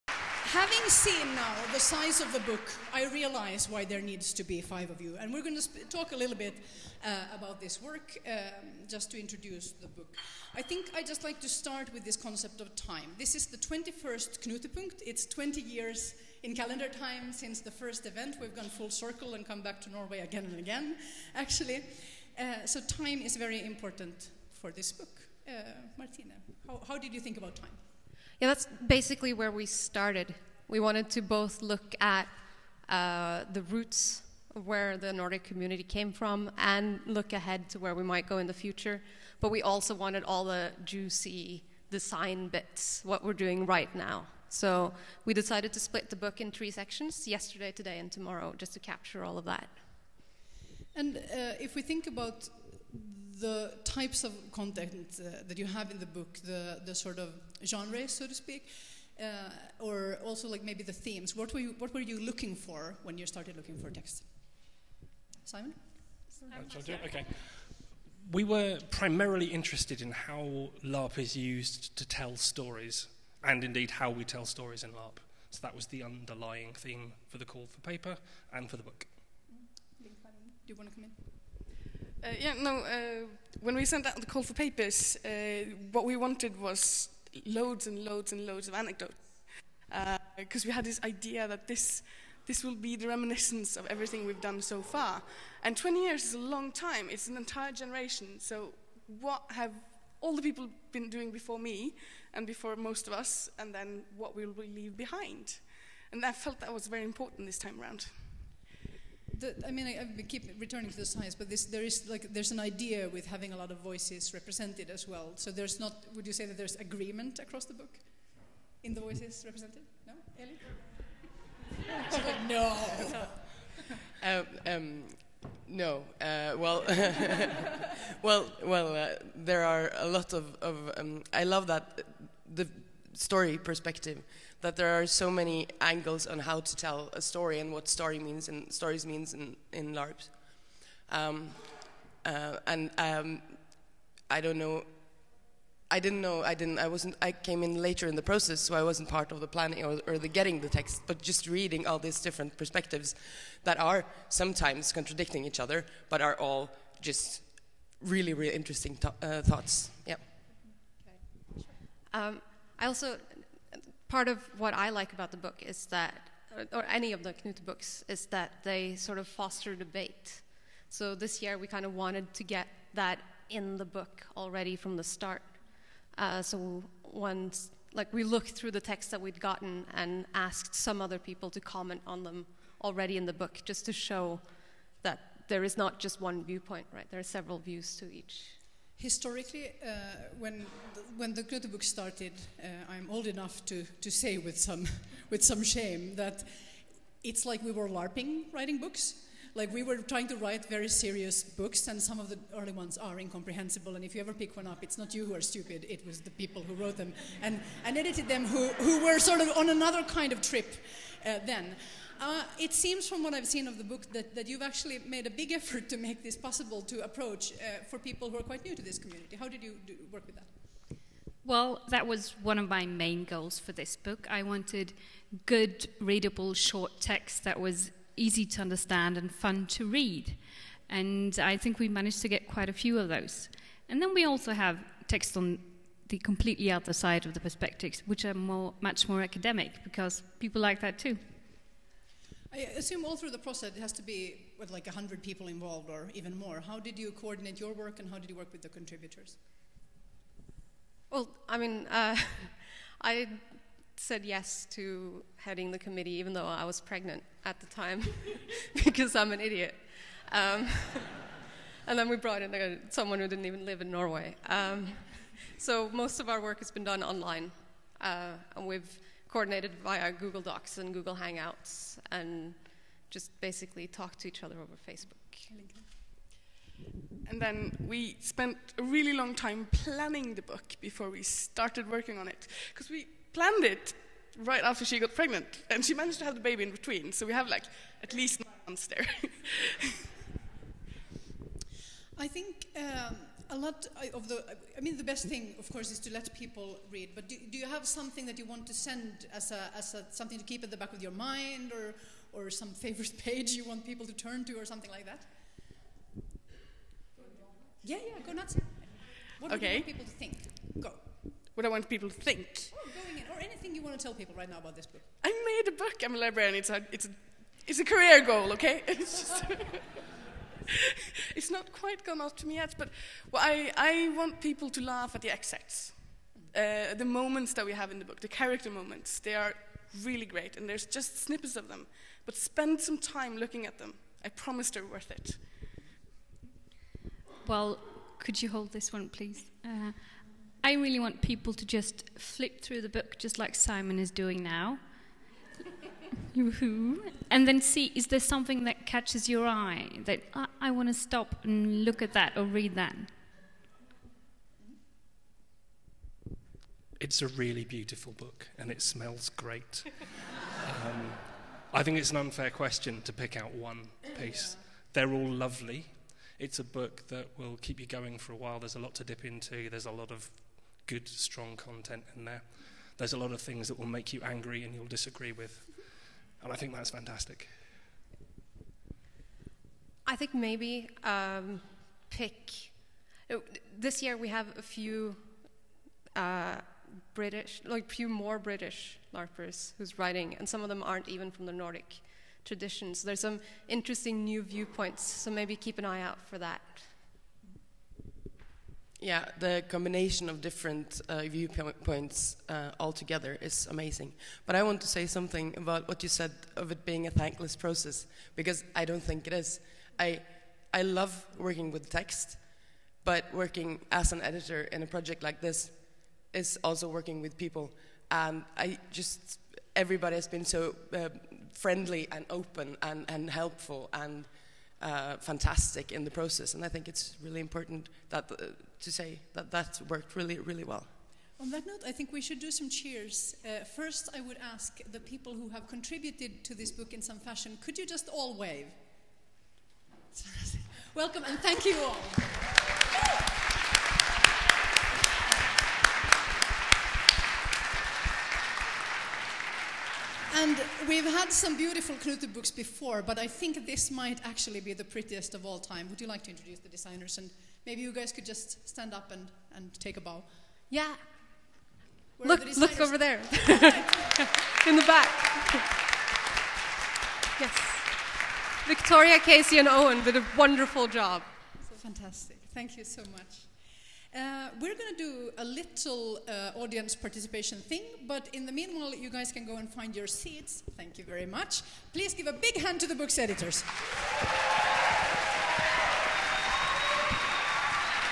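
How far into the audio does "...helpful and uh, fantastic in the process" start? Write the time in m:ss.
7:03.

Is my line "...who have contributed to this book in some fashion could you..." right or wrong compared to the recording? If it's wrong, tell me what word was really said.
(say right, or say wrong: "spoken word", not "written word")
right.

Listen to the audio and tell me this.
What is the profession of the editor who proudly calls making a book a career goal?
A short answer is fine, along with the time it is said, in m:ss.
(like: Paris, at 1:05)
librarian, at 5:16.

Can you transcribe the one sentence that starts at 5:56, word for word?
It's a really beautiful book and it smells great.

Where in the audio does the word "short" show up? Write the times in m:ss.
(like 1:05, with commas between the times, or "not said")
3:46.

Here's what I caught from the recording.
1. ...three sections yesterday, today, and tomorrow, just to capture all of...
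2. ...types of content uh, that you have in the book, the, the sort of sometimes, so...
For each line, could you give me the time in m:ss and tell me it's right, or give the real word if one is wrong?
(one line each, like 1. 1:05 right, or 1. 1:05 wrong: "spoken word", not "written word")
1. 0:46 right
2. 0:53 wrong: "genres", not "sometimes".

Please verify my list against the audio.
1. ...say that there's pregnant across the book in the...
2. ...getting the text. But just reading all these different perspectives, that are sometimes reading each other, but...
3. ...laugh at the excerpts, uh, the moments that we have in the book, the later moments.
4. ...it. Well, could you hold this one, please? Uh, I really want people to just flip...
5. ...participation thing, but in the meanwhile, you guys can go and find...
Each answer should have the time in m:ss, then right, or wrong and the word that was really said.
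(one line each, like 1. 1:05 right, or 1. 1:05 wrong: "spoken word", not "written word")
1. 1:56 wrong: "agreement", not "pregnant"
2. 2:30 wrong: "contradicting", not "reading"
3. 5:24 wrong: "character", not "later"
4. 5:35 right
5. 7:56 right.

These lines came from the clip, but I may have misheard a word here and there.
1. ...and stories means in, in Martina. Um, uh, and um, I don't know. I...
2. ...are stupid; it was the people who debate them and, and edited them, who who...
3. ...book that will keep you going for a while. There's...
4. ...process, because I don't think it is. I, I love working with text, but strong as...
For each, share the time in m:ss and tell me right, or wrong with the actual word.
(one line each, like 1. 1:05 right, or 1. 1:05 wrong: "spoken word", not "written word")
1. 2:18 wrong: "LARPs", not "Martina"
2. 3:25 wrong: "wrote", not "debate"
3. 6:06 right
4. 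6:47 wrong: "working", not "strong".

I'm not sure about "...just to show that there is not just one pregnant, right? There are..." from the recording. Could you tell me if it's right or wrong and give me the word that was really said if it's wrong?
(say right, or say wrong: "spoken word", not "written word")
wrong: "viewpoint", not "pregnant".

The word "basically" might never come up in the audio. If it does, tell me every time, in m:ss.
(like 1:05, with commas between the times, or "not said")
0:28, 4:33.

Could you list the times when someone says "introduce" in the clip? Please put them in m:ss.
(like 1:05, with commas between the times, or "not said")
0:09, 7:36.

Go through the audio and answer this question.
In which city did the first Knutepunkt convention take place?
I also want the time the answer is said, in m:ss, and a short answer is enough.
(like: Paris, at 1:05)
Göteborg, at 3:11.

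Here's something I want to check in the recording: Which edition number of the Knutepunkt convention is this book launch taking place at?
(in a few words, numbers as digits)
21st.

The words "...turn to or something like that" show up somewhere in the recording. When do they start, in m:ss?
5:04.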